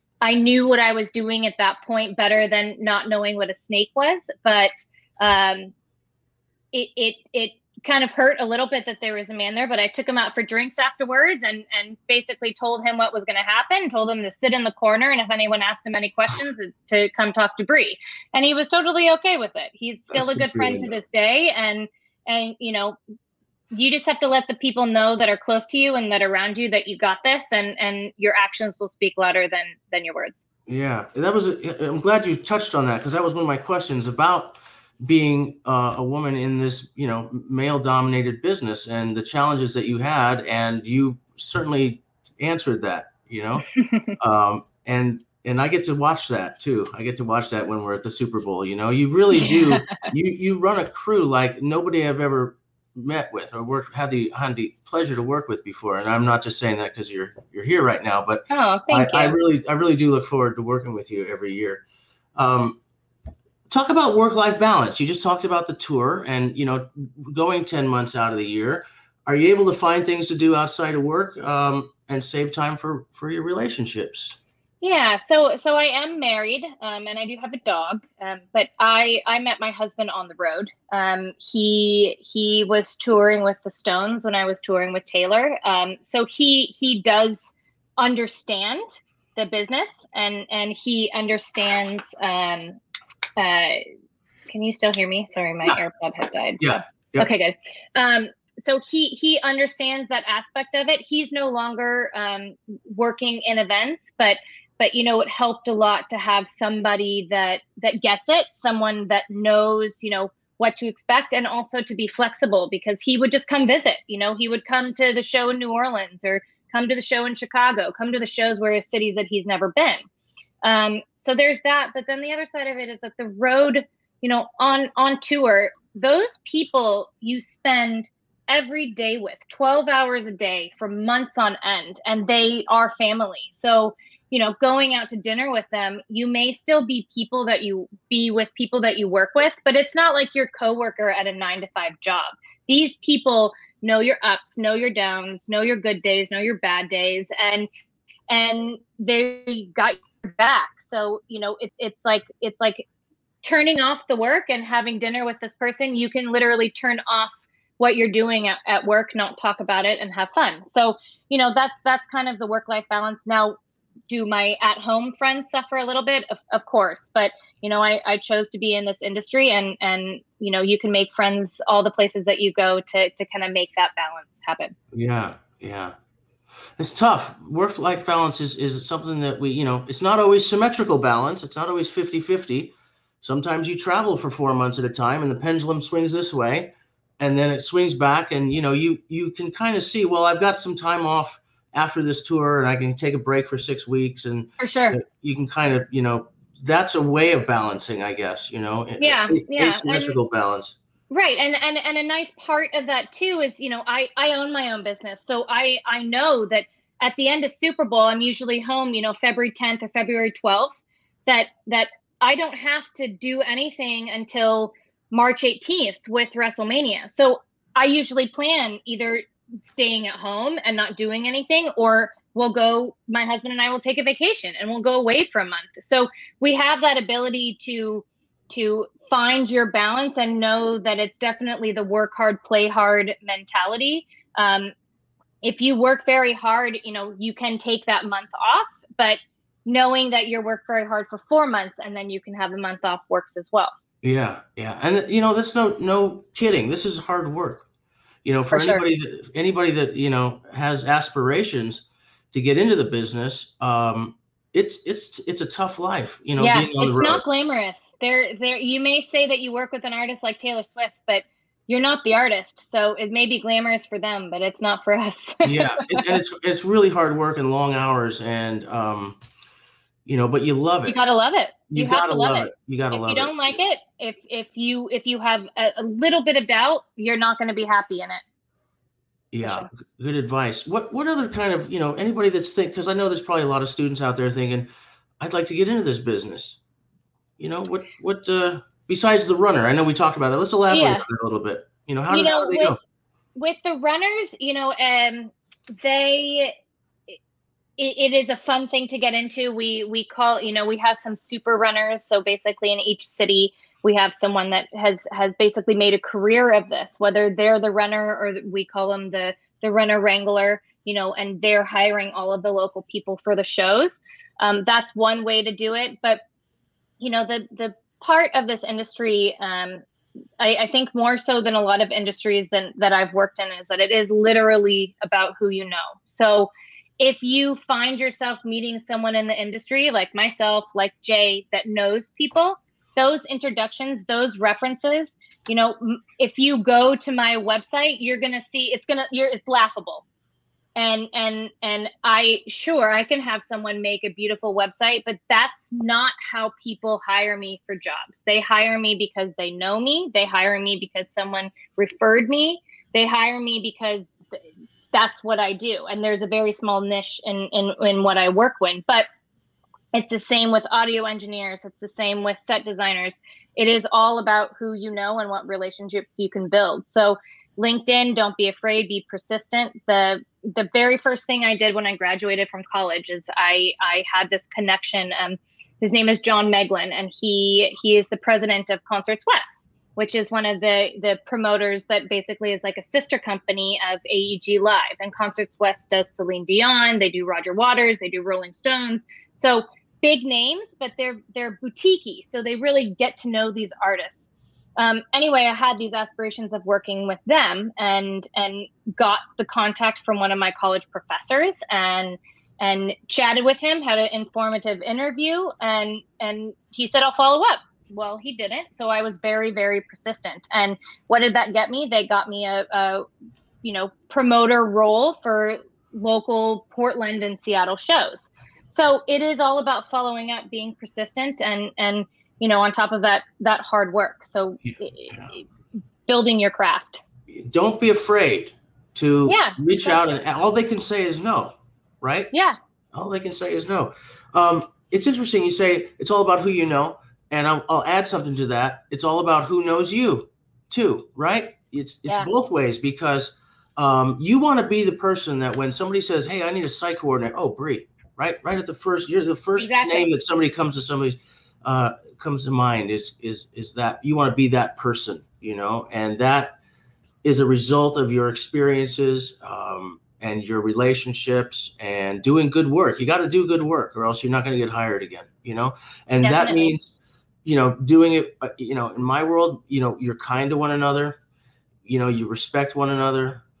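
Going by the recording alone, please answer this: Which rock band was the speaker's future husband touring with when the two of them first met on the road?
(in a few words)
The Stones.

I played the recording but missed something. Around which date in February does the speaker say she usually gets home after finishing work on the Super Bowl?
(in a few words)
February 10th.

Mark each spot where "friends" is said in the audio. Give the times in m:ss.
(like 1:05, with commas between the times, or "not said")
0:20, 2:45, 2:51.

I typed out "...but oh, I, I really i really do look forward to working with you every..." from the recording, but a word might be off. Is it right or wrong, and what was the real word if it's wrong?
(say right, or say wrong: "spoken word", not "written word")
right.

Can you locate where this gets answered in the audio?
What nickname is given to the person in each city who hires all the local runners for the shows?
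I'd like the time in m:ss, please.
5:09.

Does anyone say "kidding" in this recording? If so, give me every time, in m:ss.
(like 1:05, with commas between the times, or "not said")
4:06.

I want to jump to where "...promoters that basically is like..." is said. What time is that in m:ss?
6:21.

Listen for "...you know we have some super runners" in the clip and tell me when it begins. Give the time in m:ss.
5:00.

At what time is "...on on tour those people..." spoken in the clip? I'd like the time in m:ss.
2:04.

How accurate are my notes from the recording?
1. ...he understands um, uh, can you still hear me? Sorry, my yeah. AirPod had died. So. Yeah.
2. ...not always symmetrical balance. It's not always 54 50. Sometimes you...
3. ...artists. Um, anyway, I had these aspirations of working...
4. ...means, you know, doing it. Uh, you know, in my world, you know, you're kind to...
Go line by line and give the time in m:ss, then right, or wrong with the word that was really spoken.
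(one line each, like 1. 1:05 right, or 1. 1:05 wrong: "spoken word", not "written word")
1. 1:30 right
2. 3:00 wrong: "50", not "54"
3. 6:33 right
4. 7:46 right.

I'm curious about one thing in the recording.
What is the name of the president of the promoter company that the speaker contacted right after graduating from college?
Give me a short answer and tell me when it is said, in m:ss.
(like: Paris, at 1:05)
John Meglin, at 6:16.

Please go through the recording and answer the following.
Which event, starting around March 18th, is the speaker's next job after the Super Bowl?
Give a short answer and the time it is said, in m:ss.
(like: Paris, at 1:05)
WrestleMania, at 3:36.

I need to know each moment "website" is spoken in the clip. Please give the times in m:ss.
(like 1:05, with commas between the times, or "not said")
5:37, 5:44.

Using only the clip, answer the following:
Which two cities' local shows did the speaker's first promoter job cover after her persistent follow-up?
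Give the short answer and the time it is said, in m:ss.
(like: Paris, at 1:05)
Portland and Seattle, at 6:56.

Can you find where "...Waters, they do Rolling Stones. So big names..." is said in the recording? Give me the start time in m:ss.
6:27.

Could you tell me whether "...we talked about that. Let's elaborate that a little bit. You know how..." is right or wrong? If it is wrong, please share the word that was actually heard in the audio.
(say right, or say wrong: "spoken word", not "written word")
right.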